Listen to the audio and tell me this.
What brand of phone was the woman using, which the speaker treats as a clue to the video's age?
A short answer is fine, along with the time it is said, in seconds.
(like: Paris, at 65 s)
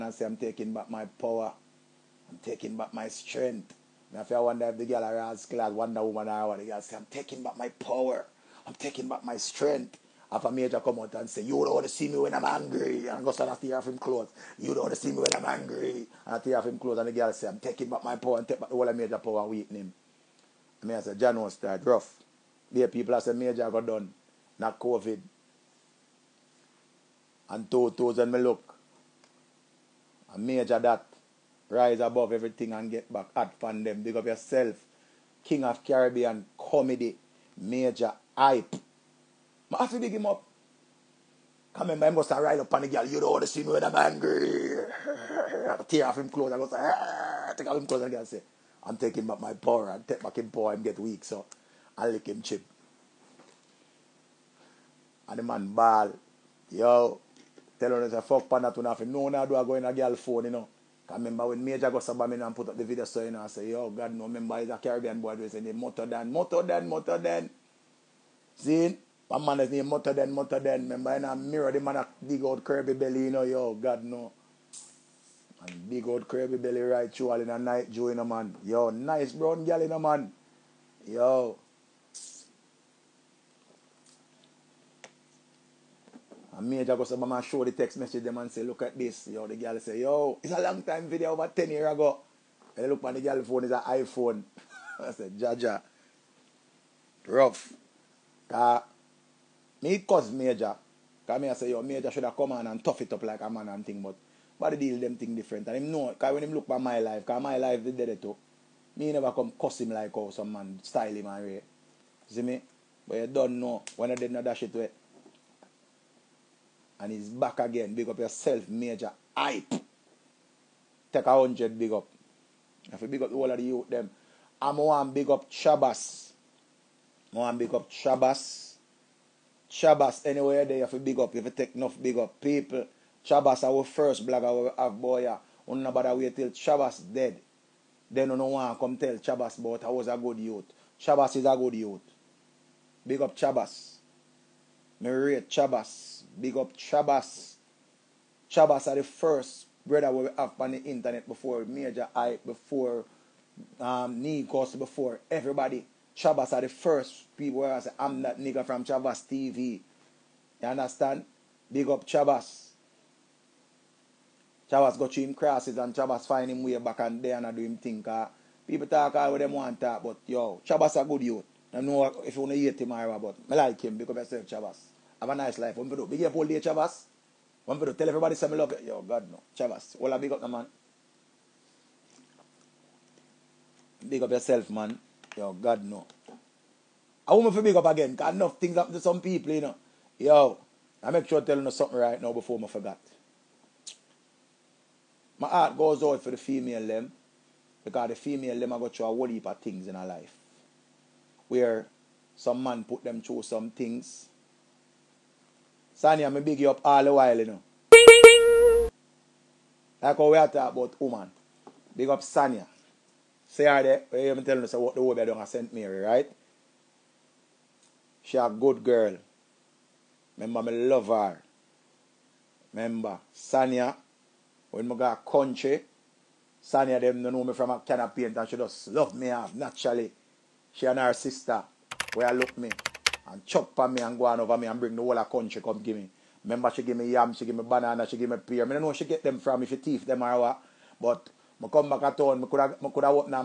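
iPhone, at 93 s.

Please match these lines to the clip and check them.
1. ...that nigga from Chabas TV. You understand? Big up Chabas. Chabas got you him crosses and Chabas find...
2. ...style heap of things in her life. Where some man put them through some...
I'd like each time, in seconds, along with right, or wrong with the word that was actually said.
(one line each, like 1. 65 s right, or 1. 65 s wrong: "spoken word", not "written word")
1. 158 s right
2. 199 s wrong: "whole", not "style".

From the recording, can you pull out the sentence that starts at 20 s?
I mean, I said, John was tired, rough.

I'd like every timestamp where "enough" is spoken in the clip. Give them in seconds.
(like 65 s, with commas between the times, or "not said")
131 s, 188 s.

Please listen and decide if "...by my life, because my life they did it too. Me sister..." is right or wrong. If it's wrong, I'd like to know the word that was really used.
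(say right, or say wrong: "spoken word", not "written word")
wrong: "never", not "sister".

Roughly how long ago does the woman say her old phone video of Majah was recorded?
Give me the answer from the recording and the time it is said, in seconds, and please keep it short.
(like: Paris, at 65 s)
over 10 years ago, at 91 s.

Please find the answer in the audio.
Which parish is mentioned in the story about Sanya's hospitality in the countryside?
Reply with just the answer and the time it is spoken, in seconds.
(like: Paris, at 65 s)
St. Mary, at 215 s.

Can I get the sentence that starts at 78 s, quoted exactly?
Yo, nice brown girl, in a man.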